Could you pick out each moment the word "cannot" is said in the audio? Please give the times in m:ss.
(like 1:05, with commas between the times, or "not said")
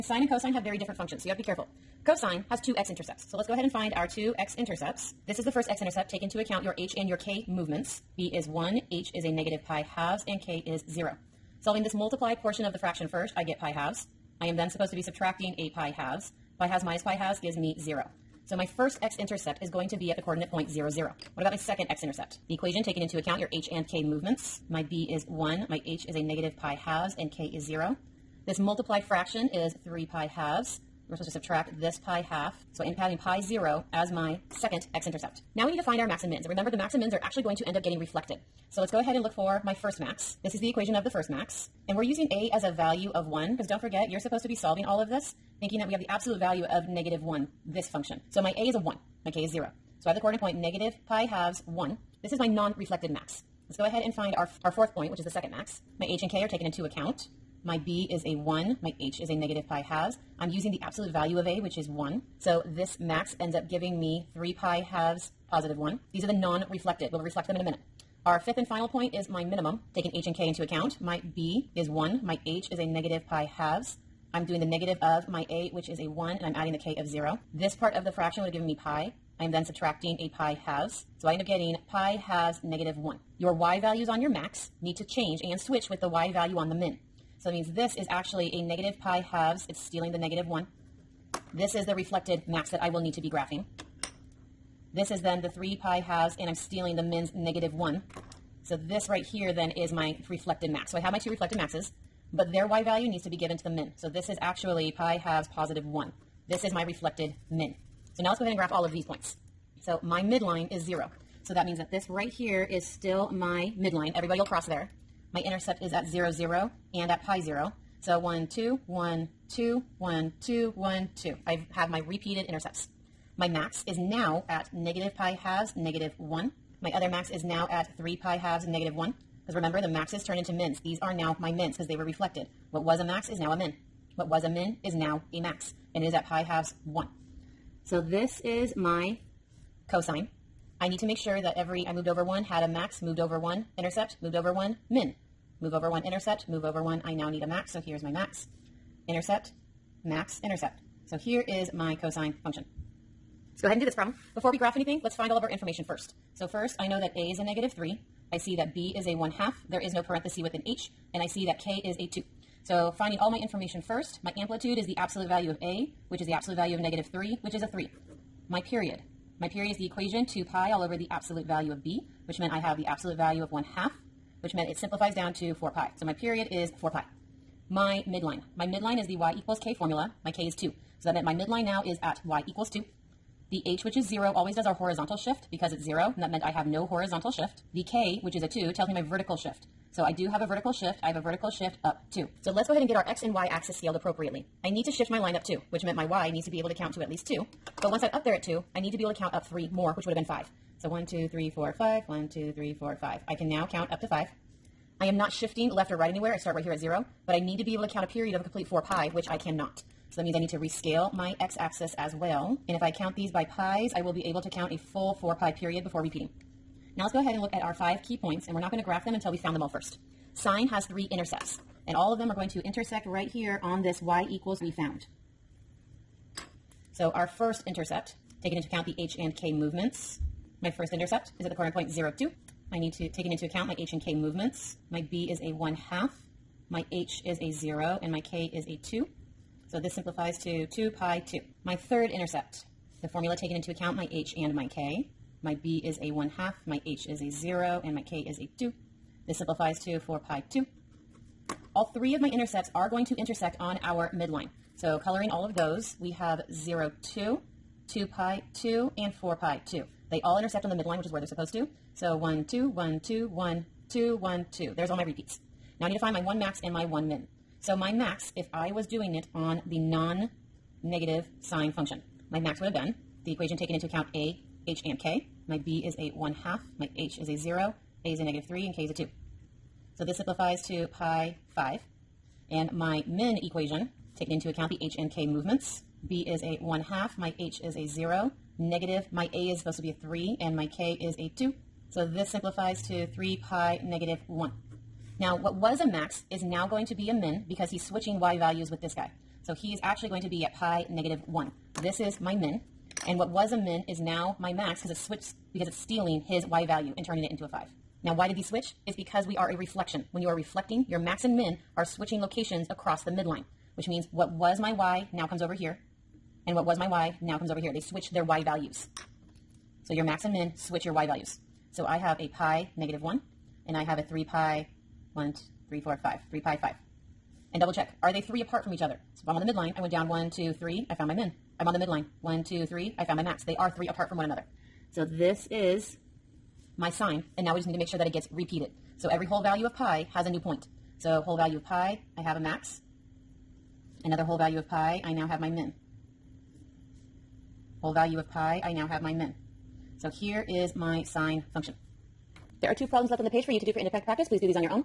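3:29.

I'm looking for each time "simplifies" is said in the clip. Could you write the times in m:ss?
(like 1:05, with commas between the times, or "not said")
2:54, 3:59, 4:09, 4:40, 4:52.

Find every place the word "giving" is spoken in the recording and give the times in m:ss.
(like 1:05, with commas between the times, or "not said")
1:03.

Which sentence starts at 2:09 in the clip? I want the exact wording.
Because remember, the maxes turn into mins.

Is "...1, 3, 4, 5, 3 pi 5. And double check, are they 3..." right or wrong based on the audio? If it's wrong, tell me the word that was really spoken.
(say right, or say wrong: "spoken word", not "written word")
right.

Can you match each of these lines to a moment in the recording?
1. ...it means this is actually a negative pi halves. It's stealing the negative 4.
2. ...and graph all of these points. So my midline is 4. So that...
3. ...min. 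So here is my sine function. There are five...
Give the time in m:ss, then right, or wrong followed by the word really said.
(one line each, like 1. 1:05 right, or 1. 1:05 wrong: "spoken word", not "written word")
1. 1:27 wrong: "1", not "4"
2. 1:48 wrong: "0", not "4"
3. 5:49 wrong: "two", not "five".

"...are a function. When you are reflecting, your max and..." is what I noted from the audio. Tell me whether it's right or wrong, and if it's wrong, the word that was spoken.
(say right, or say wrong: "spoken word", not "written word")
wrong: "reflection", not "function".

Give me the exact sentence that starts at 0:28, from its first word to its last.
This multiplied fraction is 3 pi halves.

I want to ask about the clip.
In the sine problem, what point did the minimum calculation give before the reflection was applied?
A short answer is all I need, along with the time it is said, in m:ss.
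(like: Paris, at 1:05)
(3 pi, -1), at 4:53.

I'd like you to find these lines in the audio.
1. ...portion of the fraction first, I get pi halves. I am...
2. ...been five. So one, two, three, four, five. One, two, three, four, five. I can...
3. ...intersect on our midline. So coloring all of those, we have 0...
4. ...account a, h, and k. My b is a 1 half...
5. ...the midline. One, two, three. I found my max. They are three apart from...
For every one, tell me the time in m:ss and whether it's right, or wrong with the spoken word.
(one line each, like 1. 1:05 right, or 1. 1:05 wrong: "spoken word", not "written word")
1. 0:12 right
2. 3:20 right
3. 4:13 right
4. 4:33 right
5. 5:31 right.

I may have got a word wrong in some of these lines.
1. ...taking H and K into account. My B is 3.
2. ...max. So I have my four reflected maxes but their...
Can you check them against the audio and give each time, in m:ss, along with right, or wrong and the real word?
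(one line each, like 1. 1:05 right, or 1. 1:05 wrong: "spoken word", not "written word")
1. 1:09 wrong: "1", not "3"
2. 1:40 wrong: "two", not "four".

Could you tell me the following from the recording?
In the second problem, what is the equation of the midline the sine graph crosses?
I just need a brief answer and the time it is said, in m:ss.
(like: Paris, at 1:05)
y = 2, at 3:02.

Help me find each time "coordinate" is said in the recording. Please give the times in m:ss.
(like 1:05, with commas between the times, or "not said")
0:20, 0:50, 3:51.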